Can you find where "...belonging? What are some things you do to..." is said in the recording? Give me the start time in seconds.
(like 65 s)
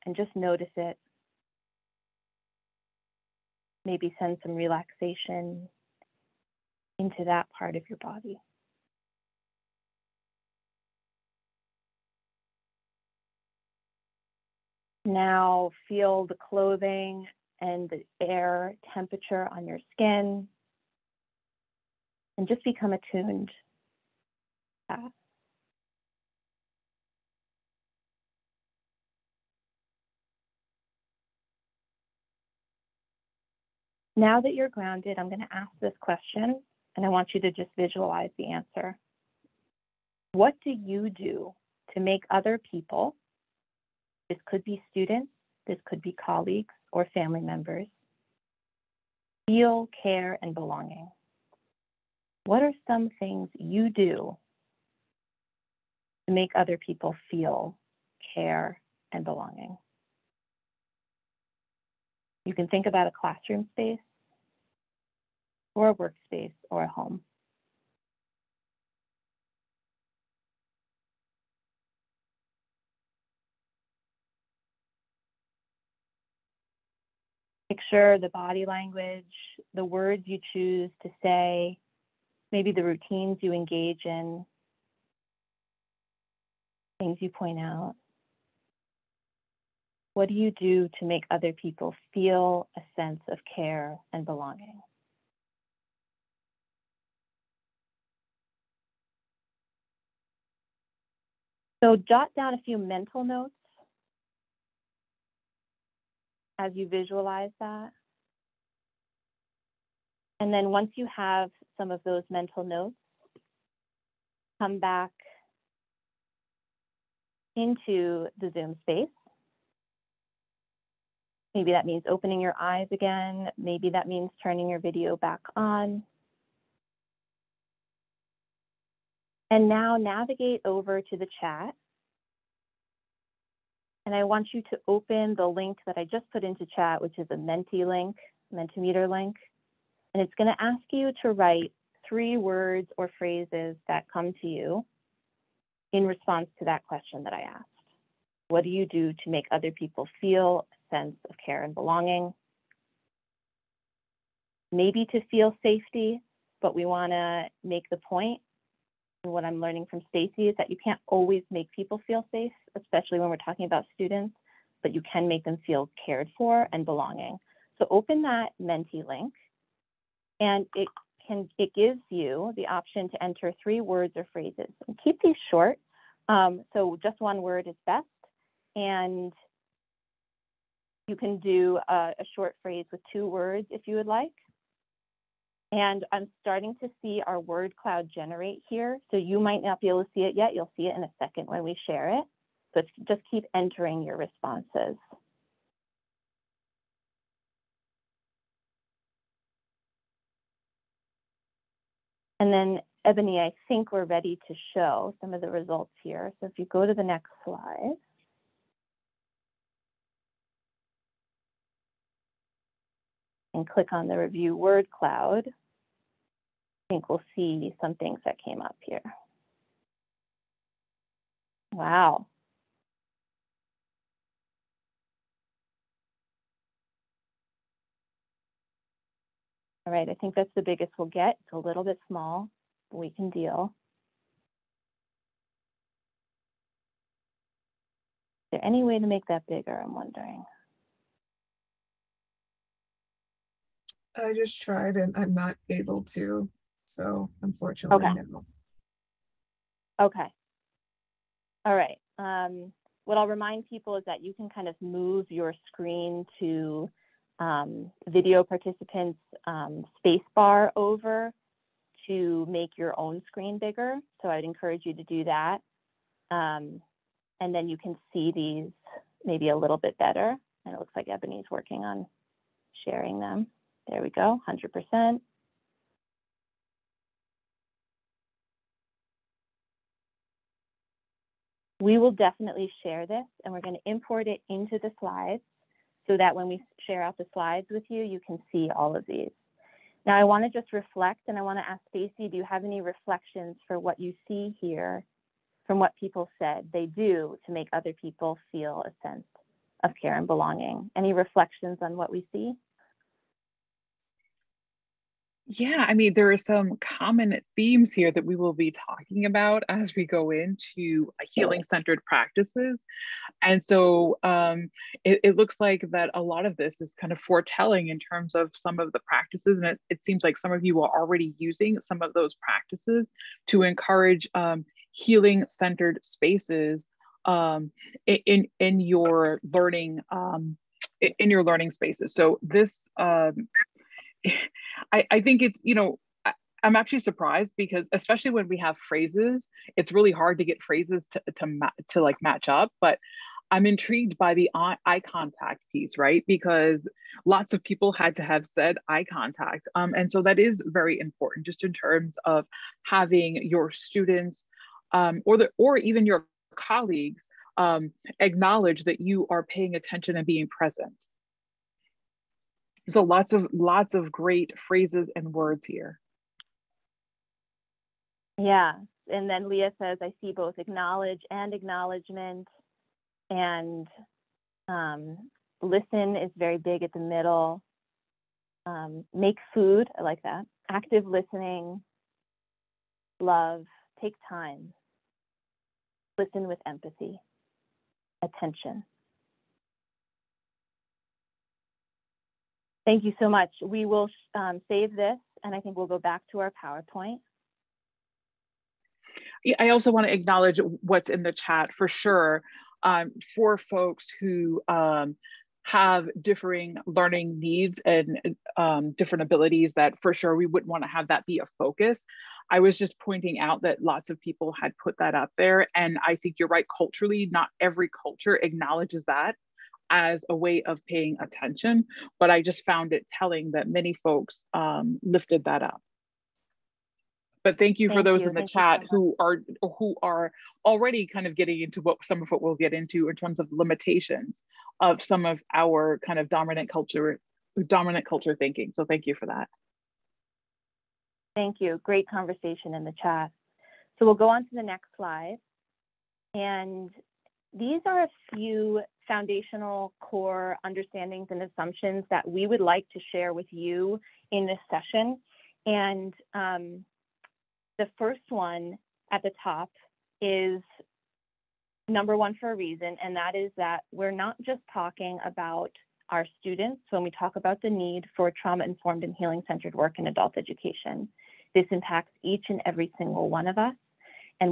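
50 s.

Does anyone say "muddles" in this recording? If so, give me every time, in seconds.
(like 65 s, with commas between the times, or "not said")
not said.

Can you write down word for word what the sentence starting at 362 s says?
So lots of lots of great phrases and words here.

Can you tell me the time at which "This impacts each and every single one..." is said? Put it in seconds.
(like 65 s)
471 s.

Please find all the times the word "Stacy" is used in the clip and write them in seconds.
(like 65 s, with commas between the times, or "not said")
160 s, 291 s.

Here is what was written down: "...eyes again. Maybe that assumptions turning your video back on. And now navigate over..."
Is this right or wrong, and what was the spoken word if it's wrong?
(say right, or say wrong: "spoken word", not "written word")
wrong: "means", not "assumptions".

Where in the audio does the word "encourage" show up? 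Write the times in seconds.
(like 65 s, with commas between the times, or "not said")
264 s, 323 s.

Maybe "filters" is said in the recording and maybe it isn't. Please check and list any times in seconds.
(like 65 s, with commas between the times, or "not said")
not said.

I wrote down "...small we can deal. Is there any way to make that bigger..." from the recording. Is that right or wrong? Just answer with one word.
right.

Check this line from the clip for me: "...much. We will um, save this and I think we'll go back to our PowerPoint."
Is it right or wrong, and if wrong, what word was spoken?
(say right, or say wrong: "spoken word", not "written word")
right.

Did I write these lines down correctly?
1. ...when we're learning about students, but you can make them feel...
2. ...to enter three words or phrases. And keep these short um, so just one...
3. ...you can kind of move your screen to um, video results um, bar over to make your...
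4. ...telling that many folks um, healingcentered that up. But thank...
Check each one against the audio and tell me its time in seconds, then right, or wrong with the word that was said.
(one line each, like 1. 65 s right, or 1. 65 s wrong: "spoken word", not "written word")
1. 163 s wrong: "talking", not "learning"
2. 173 s right
3. 254 s wrong: "participants", not "results"
4. 423 s wrong: "lifted", not "healingcentered".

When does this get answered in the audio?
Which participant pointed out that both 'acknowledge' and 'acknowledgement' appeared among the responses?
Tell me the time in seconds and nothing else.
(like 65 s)
369 s.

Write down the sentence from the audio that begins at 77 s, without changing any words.
Picture the body language, the words you choose to say, maybe the routines you engage in, things you point out?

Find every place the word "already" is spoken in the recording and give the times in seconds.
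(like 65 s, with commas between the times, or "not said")
320 s, 430 s.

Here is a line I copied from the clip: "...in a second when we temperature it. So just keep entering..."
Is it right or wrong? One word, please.
wrong.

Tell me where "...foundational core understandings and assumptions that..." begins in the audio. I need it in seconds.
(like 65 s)
449 s.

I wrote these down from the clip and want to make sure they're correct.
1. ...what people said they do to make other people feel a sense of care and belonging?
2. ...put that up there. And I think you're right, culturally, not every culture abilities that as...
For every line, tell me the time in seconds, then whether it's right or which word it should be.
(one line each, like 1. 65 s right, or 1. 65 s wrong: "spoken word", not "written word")
1. 295 s right
2. 414 s wrong: "acknowledges", not "abilities".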